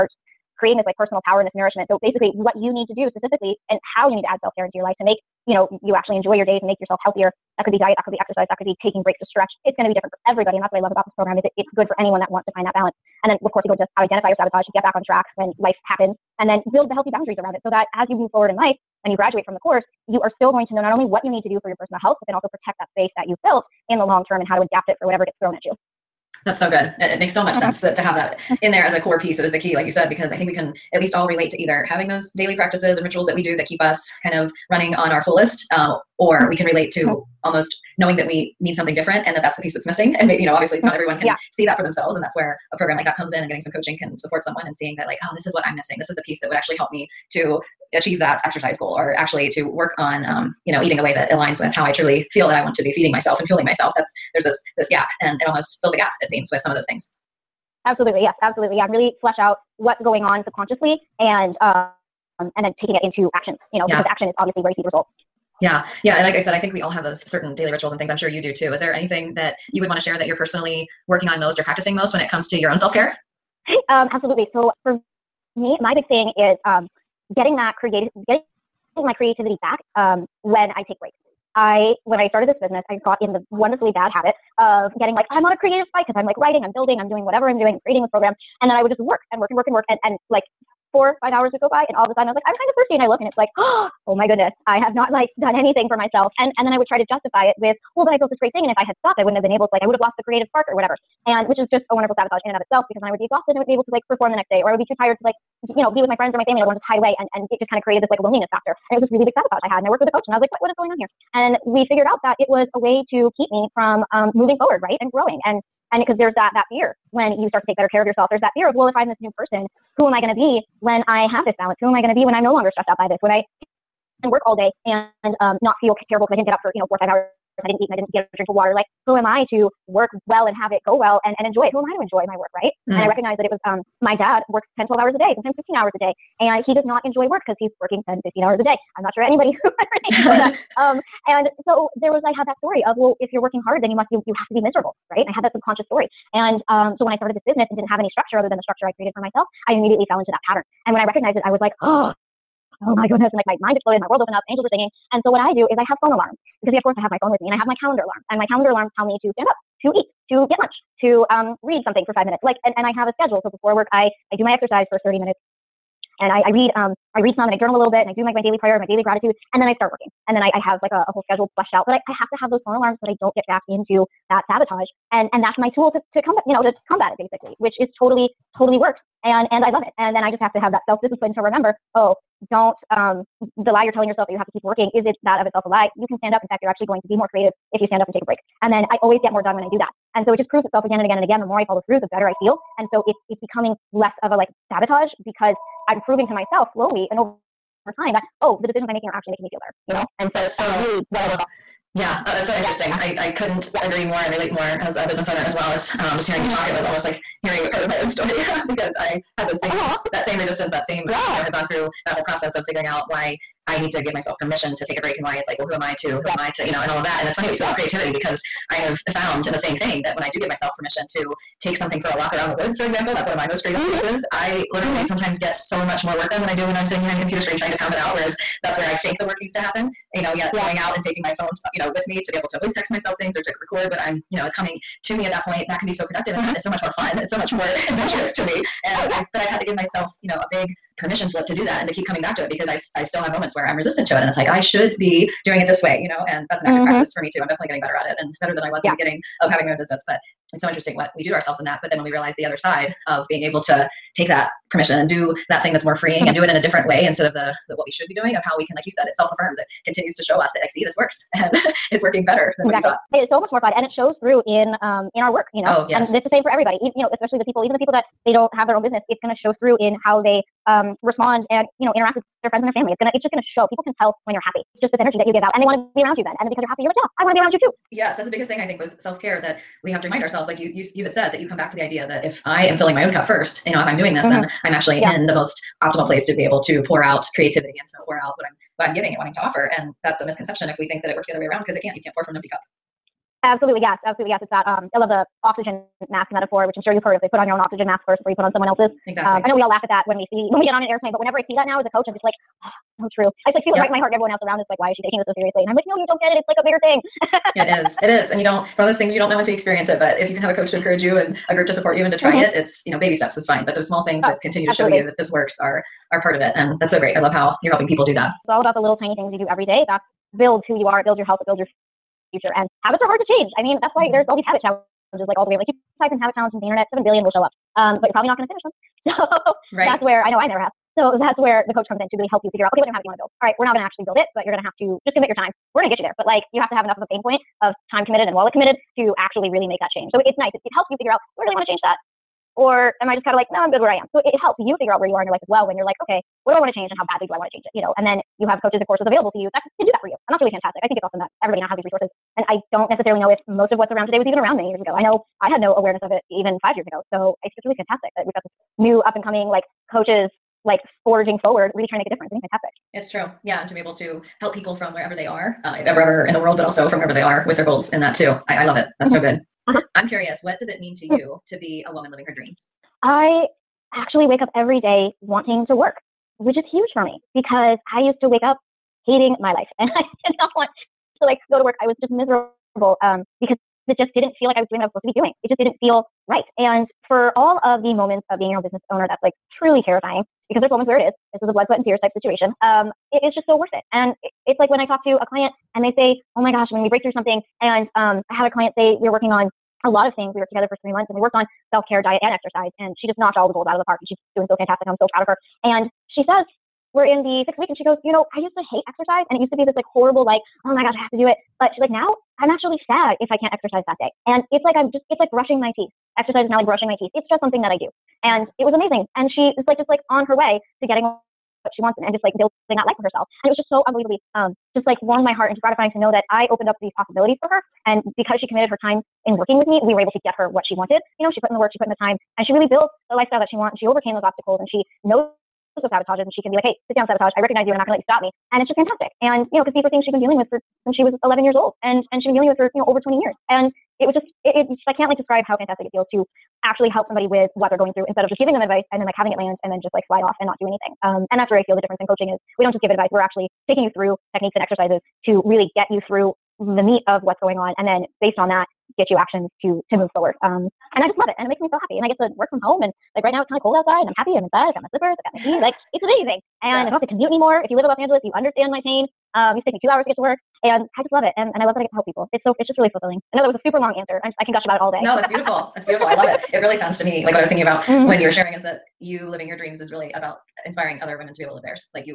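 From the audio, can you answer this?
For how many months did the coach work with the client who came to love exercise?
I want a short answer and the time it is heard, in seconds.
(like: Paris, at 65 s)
three months, at 400 s.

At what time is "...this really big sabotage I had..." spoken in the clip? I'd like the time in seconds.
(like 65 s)
109 s.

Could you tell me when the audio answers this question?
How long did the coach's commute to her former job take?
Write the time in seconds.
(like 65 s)
469 s.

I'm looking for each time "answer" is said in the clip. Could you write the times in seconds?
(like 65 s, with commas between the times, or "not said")
474 s.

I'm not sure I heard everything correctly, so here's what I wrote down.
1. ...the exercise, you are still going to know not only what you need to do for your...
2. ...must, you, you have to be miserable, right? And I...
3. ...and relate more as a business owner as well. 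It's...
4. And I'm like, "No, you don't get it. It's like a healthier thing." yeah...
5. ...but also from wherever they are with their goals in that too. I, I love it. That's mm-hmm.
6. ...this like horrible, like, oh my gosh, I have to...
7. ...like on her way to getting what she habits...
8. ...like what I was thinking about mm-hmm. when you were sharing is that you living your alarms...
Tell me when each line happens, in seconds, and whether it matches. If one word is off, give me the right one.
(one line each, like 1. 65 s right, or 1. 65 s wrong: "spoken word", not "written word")
1. 19 s wrong: "course", not "exercise"
2. 143 s right
3. 204 s right
4. 305 s wrong: "bigger", not "healthier"
5. 366 s right
6. 409 s right
7. 419 s wrong: "wants", not "habits"
8. 477 s wrong: "dreams", not "alarms".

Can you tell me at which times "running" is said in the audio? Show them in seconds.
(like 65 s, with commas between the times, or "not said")
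34 s.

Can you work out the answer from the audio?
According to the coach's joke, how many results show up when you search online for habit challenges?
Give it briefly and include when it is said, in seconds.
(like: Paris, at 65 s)
seven billion, at 326 s.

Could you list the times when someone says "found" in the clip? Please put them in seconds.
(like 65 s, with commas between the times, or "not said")
219 s.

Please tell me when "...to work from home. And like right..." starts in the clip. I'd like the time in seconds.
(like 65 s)
462 s.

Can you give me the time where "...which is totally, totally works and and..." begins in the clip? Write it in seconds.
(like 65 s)
177 s.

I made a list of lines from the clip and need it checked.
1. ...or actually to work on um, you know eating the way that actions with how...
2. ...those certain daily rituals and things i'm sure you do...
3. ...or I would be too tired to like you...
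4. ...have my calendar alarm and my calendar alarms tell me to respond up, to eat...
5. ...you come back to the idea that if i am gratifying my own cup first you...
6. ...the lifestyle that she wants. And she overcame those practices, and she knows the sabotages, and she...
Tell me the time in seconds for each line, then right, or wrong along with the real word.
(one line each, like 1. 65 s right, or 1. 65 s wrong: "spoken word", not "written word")
1. 48 s wrong: "aligns", not "actions"
2. 67 s right
3. 104 s right
4. 157 s wrong: "stand", not "respond"
5. 281 s wrong: "filling", not "gratifying"
6. 433 s wrong: "obstacles", not "practices".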